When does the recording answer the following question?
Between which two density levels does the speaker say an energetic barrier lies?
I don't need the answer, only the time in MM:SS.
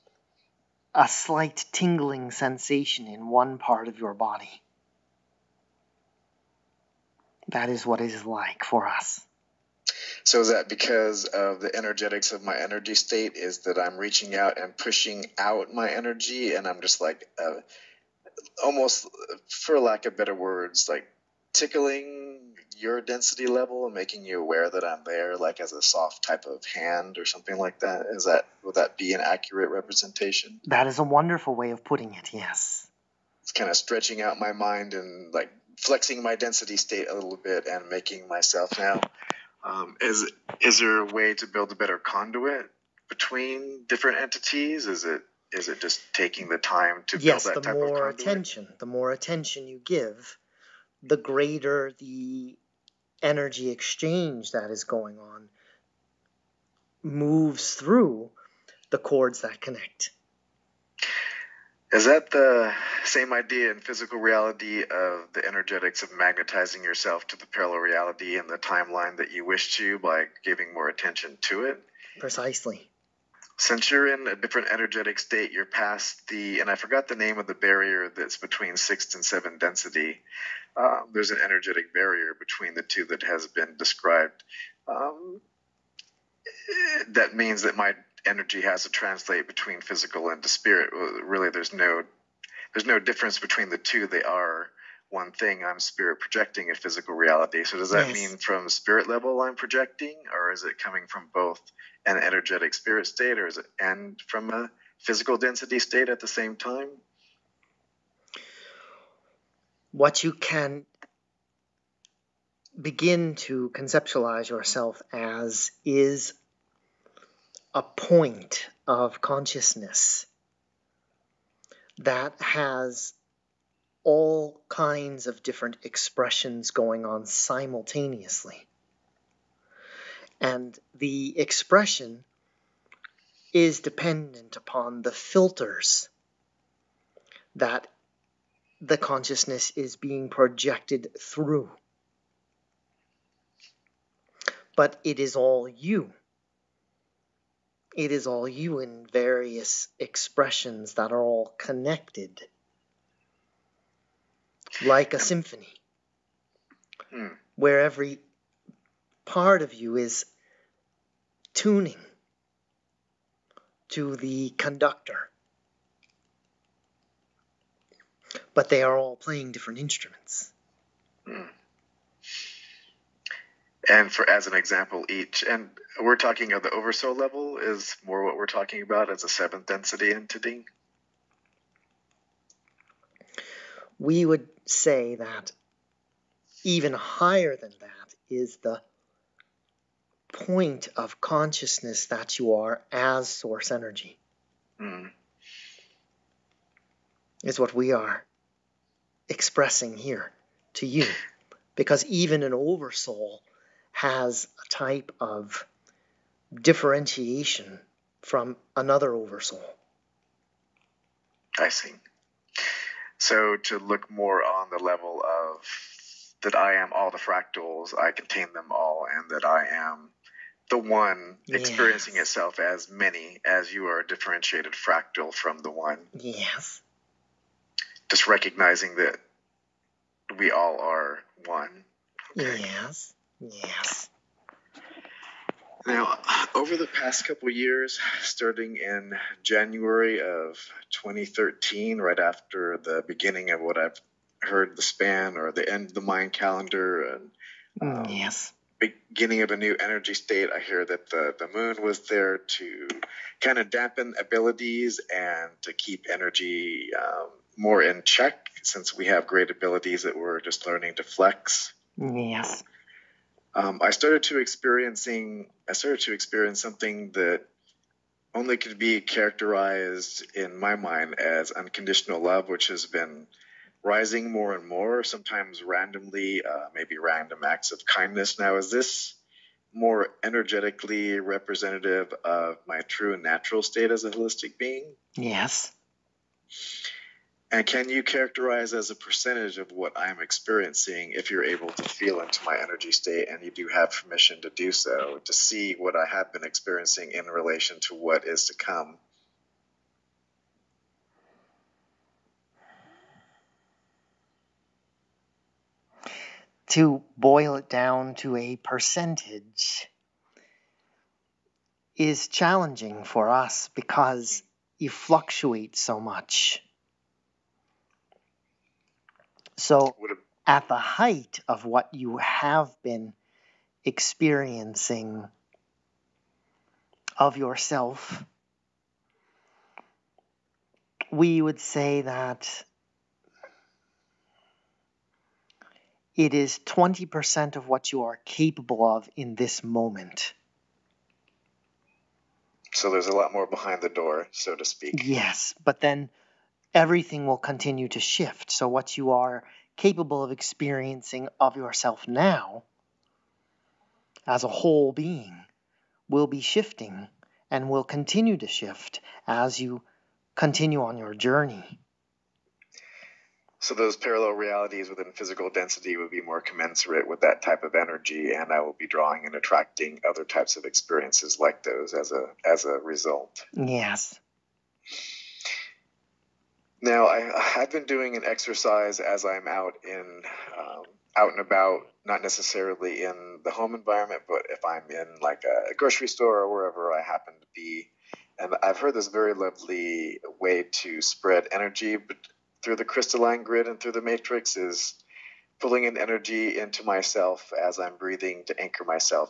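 01:18.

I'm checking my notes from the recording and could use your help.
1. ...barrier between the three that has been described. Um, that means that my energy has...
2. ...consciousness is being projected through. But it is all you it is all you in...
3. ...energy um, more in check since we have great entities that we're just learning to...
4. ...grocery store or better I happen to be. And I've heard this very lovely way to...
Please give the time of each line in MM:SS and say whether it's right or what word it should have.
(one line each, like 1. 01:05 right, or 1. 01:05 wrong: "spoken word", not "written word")
1. 01:21 wrong: "two", not "three"
2. 02:18 right
3. 04:16 wrong: "abilities", not "entities"
4. 06:25 wrong: "wherever", not "better".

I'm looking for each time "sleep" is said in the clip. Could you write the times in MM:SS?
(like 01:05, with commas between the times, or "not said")
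not said.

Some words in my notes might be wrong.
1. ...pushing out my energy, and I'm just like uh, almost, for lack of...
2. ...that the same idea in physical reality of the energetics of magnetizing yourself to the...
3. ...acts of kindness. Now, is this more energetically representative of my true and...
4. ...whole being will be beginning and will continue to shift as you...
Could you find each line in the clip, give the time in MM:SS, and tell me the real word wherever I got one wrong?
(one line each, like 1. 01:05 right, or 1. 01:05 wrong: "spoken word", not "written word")
1. 00:14 right
2. 01:02 right
3. 04:37 right
4. 05:54 wrong: "shifting", not "beginning".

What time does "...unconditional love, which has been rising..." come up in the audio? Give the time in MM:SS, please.
04:31.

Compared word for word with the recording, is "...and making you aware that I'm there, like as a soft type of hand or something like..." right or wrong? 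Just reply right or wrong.
right.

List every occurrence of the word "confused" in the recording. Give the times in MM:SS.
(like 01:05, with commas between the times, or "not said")
not said.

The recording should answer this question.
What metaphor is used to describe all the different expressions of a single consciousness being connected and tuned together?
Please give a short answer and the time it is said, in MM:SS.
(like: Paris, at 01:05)
a symphony, at 02:35.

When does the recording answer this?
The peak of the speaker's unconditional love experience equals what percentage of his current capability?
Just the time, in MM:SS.
05:36.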